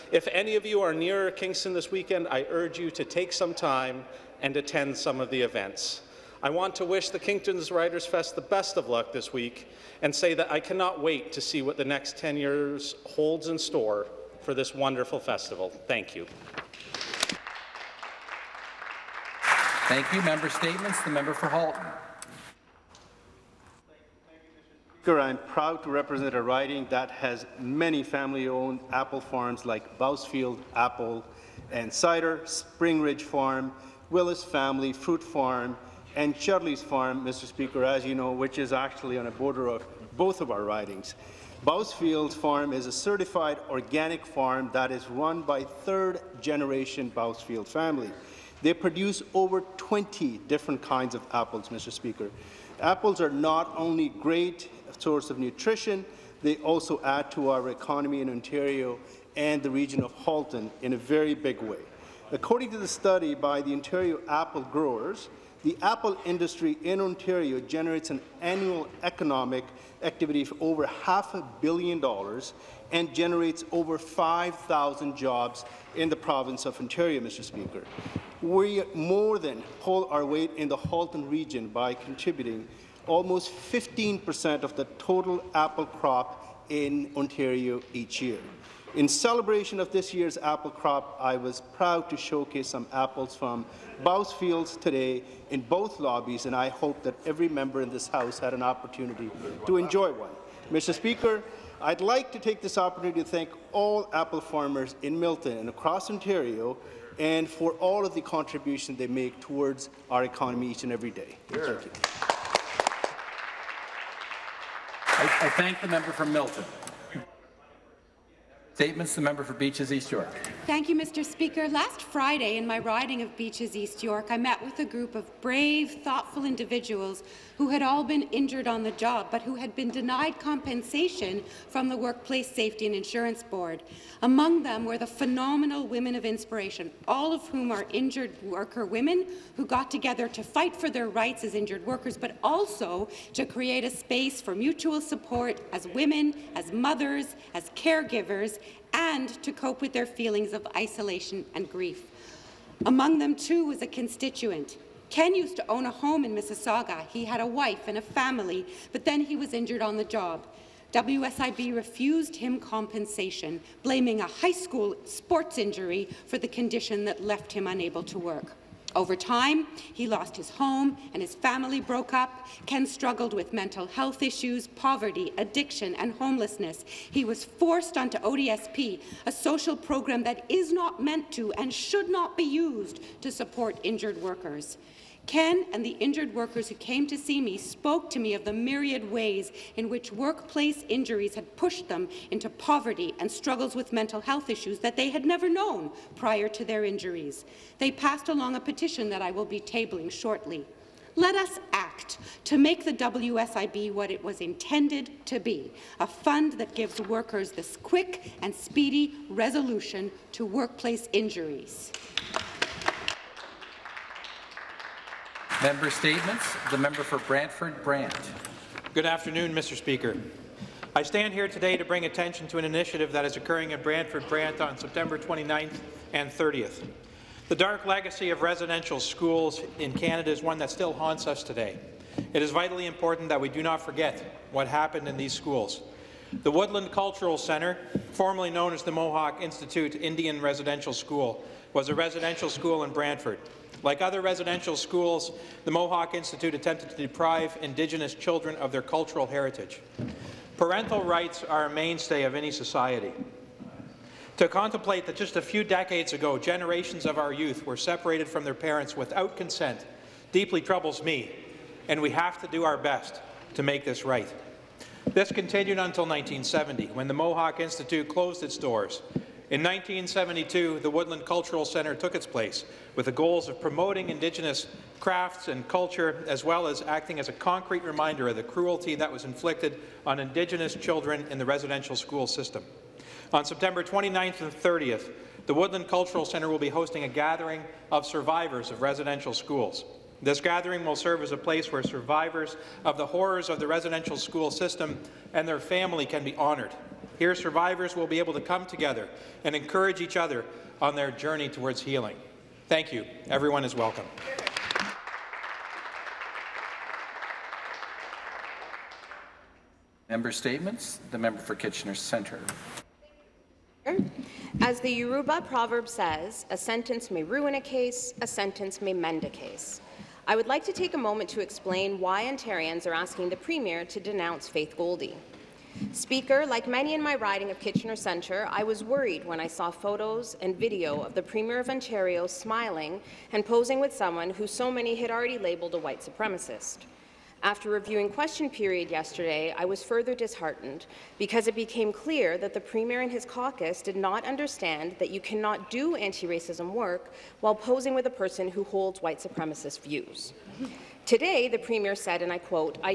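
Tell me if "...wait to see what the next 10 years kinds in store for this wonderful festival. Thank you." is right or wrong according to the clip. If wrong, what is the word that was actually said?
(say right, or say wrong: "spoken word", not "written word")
wrong: "holds", not "kinds".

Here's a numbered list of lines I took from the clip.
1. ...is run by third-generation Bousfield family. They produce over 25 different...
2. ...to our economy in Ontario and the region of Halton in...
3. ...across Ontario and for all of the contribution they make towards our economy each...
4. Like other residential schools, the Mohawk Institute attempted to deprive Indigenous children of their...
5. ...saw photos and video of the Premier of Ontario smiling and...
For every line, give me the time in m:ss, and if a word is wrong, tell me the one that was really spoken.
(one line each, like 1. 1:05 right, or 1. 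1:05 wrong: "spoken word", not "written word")
1. 0:44 wrong: "20", not "25"
2. 0:57 right
3. 1:45 right
4. 4:03 right
5. 5:29 right.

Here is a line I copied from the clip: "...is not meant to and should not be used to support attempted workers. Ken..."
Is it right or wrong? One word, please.
wrong.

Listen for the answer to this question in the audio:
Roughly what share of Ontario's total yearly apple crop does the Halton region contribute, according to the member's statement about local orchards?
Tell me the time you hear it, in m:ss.
1:23.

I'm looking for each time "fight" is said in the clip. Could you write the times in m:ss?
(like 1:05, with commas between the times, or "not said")
2:20.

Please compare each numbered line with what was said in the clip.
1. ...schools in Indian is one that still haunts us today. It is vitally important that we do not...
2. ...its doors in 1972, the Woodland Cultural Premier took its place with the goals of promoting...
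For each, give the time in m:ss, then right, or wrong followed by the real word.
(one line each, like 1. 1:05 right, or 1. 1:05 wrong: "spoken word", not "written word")
1. 3:48 wrong: "Canada", not "Indian"
2. 4:28 wrong: "Centre", not "Premier".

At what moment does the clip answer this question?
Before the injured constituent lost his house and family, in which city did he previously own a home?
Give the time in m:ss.
2:36.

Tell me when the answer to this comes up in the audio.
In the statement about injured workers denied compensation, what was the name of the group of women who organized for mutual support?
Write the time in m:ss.
2:15.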